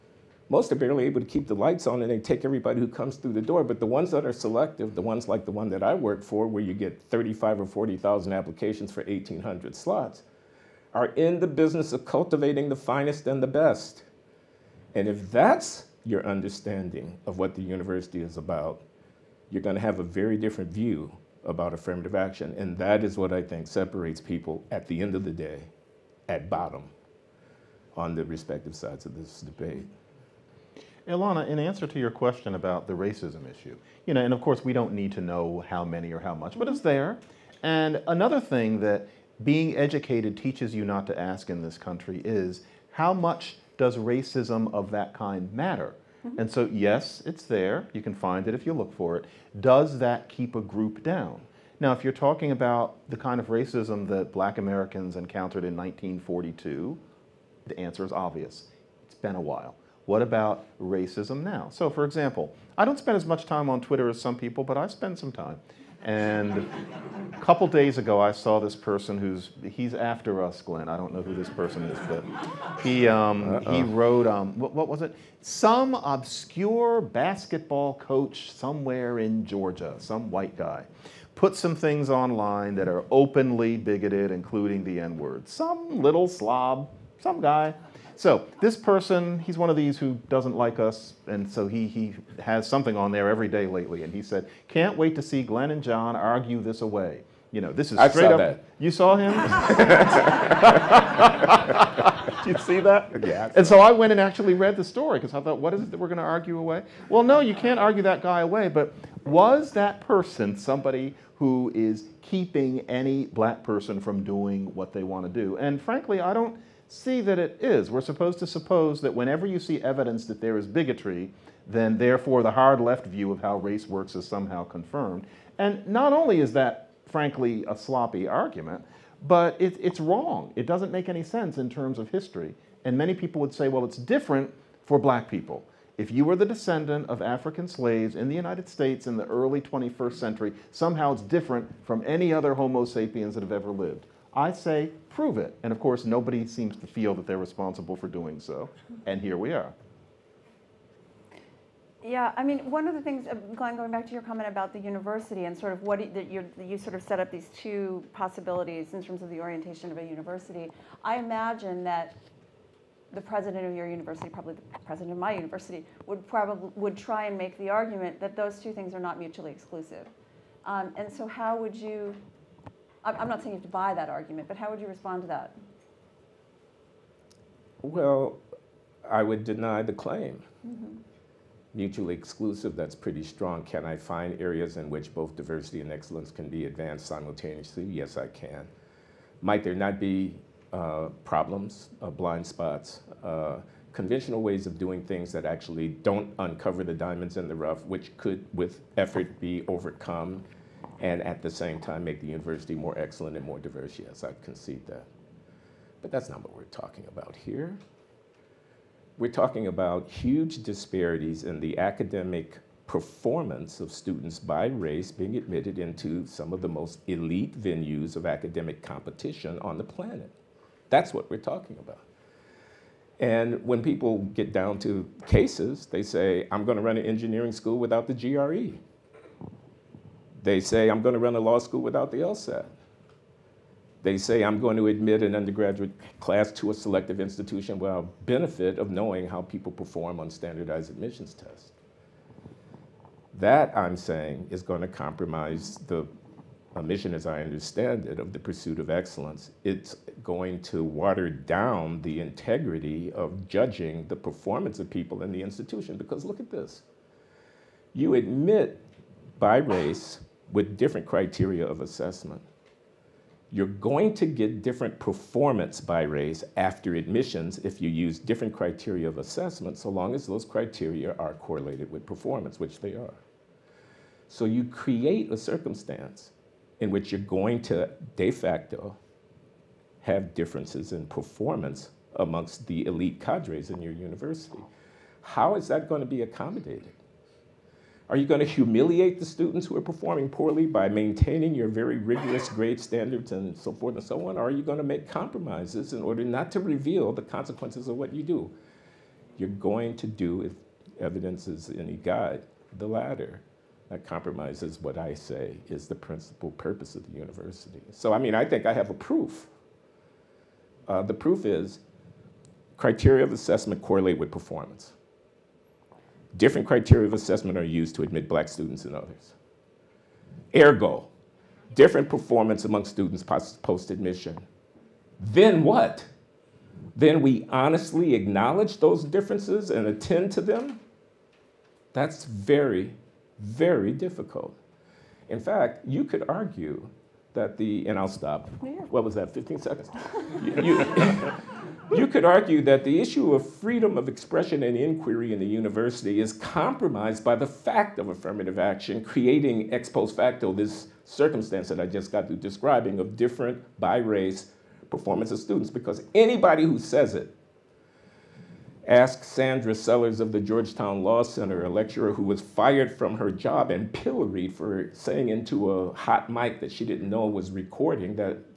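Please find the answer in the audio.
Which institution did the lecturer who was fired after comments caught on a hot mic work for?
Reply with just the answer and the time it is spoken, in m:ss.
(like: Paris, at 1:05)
Georgetown Law Center, at 6:00.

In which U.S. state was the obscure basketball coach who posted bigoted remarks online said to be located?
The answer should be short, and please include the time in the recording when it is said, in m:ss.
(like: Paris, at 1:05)
Georgia, at 1:19.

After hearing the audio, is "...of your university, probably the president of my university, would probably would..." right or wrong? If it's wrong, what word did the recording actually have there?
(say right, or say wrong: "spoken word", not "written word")
right.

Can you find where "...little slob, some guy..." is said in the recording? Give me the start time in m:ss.
1:26.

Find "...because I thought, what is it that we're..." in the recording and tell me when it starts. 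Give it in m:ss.
1:45.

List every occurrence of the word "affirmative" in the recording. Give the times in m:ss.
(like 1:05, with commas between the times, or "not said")
0:21, 5:48.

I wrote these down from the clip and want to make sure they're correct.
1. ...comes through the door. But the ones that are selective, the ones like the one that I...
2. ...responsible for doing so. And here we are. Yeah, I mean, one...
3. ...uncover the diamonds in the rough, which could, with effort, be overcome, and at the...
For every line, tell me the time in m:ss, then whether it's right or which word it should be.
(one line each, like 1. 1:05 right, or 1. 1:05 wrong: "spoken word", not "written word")
1. 0:02 right
2. 2:27 right
3. 3:16 right.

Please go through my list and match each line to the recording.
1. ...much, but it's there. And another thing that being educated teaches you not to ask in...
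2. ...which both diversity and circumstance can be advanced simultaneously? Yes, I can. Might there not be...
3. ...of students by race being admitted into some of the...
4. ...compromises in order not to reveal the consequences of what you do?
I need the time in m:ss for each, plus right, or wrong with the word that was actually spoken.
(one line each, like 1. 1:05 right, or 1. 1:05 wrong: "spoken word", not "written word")
1. 0:36 right
2. 3:04 wrong: "excellence", not "circumstance"
3. 3:33 right
4. 4:55 right.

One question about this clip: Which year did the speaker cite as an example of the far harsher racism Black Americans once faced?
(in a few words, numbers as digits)
1942.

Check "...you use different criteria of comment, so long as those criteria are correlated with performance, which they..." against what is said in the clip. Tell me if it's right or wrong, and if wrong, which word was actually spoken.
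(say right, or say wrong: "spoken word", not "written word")
wrong: "assessment", not "comment".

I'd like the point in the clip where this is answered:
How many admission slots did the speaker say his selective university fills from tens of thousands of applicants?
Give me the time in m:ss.
0:09.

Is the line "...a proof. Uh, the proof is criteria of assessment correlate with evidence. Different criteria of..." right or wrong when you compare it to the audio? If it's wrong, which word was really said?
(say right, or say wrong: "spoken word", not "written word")
wrong: "performance", not "evidence".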